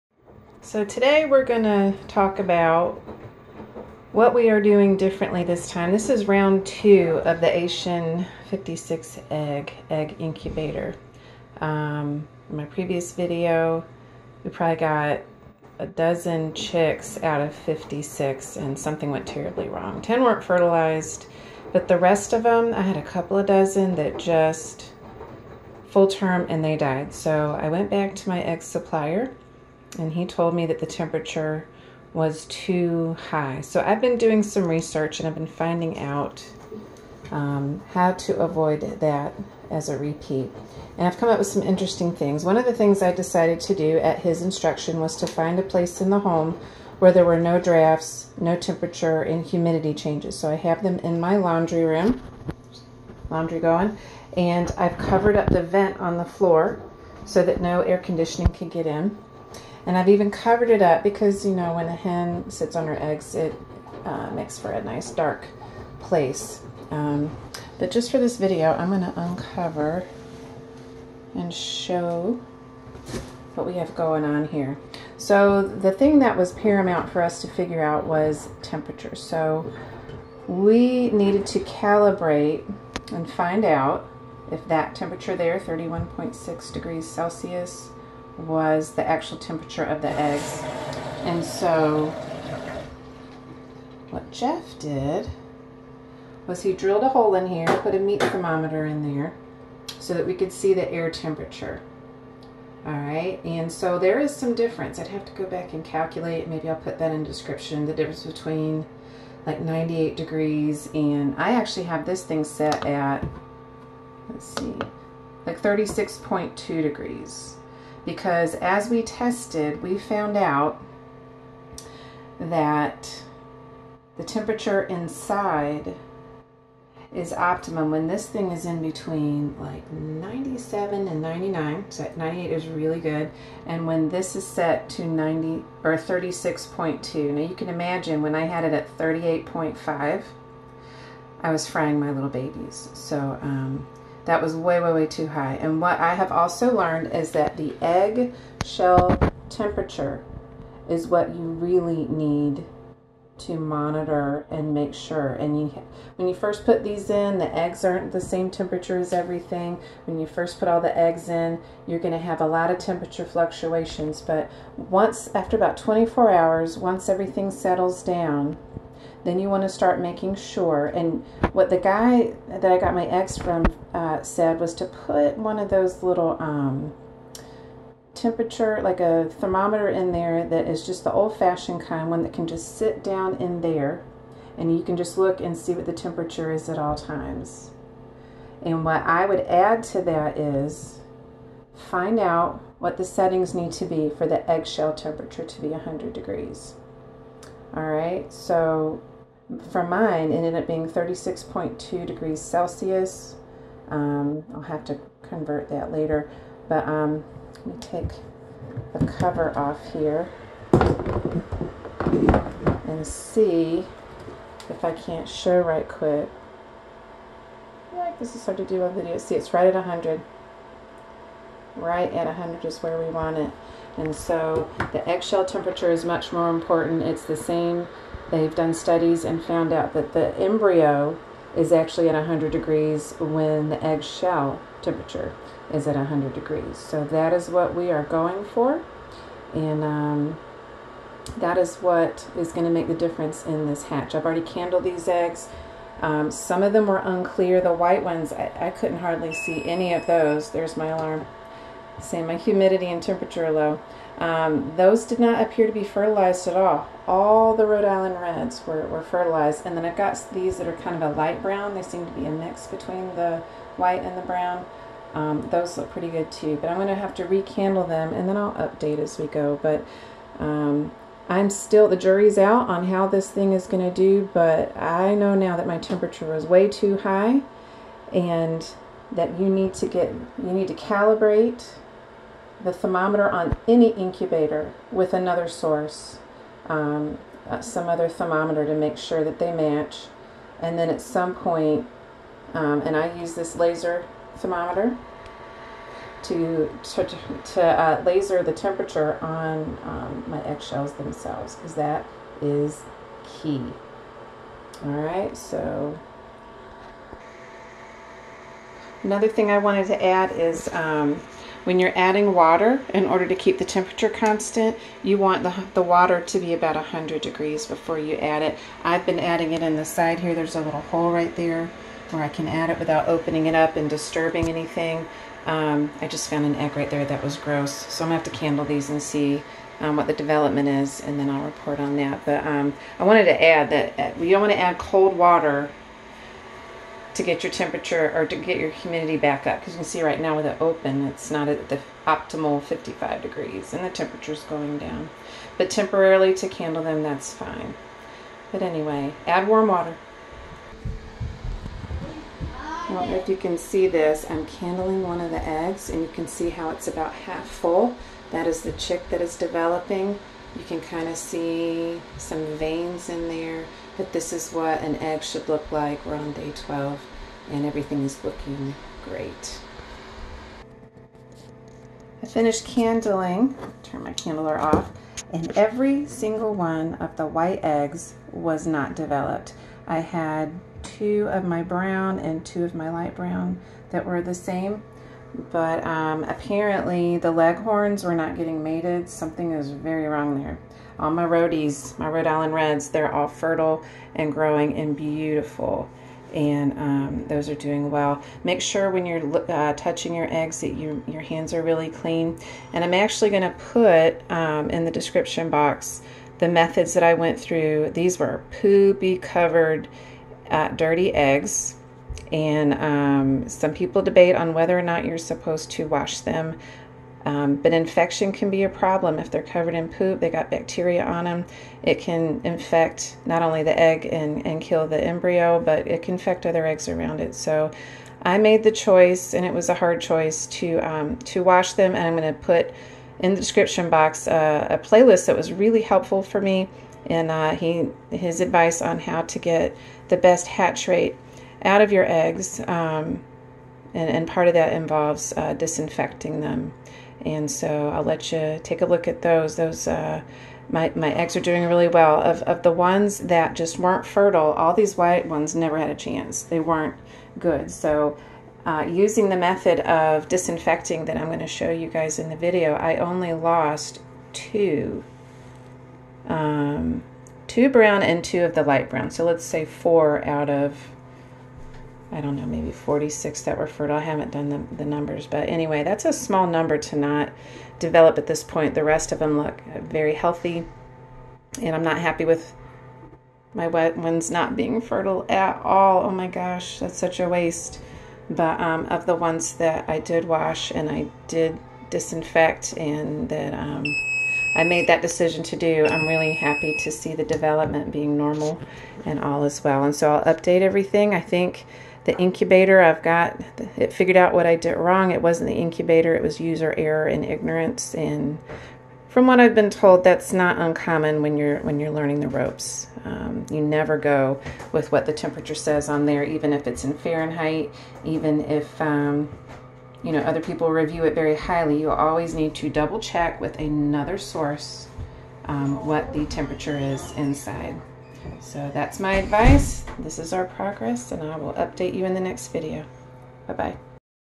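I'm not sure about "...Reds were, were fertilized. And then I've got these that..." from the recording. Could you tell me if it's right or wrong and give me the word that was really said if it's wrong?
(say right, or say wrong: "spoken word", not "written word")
right.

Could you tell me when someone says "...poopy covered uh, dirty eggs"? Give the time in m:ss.
6:48.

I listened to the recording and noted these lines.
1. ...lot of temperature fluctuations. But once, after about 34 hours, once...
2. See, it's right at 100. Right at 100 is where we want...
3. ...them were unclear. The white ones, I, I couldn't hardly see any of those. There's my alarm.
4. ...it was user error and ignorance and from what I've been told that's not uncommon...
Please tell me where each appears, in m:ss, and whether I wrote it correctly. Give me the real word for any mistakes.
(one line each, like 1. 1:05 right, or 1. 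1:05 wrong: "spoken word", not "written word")
1. 2:42 wrong: "24", not "34"
2. 3:39 right
3. 4:06 right
4. 8:26 right.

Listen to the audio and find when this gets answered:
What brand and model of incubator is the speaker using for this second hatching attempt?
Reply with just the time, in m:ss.
0:07.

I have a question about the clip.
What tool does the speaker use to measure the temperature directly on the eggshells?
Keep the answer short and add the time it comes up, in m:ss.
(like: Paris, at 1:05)
laser thermometer, at 4:53.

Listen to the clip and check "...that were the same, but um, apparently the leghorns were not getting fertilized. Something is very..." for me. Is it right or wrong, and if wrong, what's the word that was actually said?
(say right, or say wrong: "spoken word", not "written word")
wrong: "mated", not "fertilized".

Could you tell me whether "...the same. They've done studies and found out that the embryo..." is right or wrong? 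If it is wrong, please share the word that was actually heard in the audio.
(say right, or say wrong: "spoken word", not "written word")
right.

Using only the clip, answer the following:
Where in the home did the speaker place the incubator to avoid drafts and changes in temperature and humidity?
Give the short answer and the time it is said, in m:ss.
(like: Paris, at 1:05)
laundry room, at 0:51.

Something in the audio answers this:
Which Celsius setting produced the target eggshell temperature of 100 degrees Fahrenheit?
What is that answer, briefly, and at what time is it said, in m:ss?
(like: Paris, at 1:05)
36.2 degrees Celsius, at 3:20.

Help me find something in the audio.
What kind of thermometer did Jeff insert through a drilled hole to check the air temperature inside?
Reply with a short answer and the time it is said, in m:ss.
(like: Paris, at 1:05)
meat thermometer, at 1:37.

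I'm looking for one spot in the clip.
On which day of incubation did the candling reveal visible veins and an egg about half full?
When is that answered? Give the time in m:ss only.
6:06.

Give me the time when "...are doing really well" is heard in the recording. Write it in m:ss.
7:31.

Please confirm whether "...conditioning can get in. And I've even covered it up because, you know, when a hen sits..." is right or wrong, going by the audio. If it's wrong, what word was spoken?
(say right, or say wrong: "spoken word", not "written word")
right.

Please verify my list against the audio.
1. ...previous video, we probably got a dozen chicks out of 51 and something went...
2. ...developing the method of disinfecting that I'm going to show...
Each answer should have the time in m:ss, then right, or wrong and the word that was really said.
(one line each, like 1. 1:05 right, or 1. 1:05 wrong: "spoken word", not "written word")
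1. 0:12 wrong: "56", not "51"
2. 7:38 wrong: "using", not "developing".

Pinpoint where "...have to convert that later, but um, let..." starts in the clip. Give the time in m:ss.
3:24.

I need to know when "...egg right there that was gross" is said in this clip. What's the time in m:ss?
5:26.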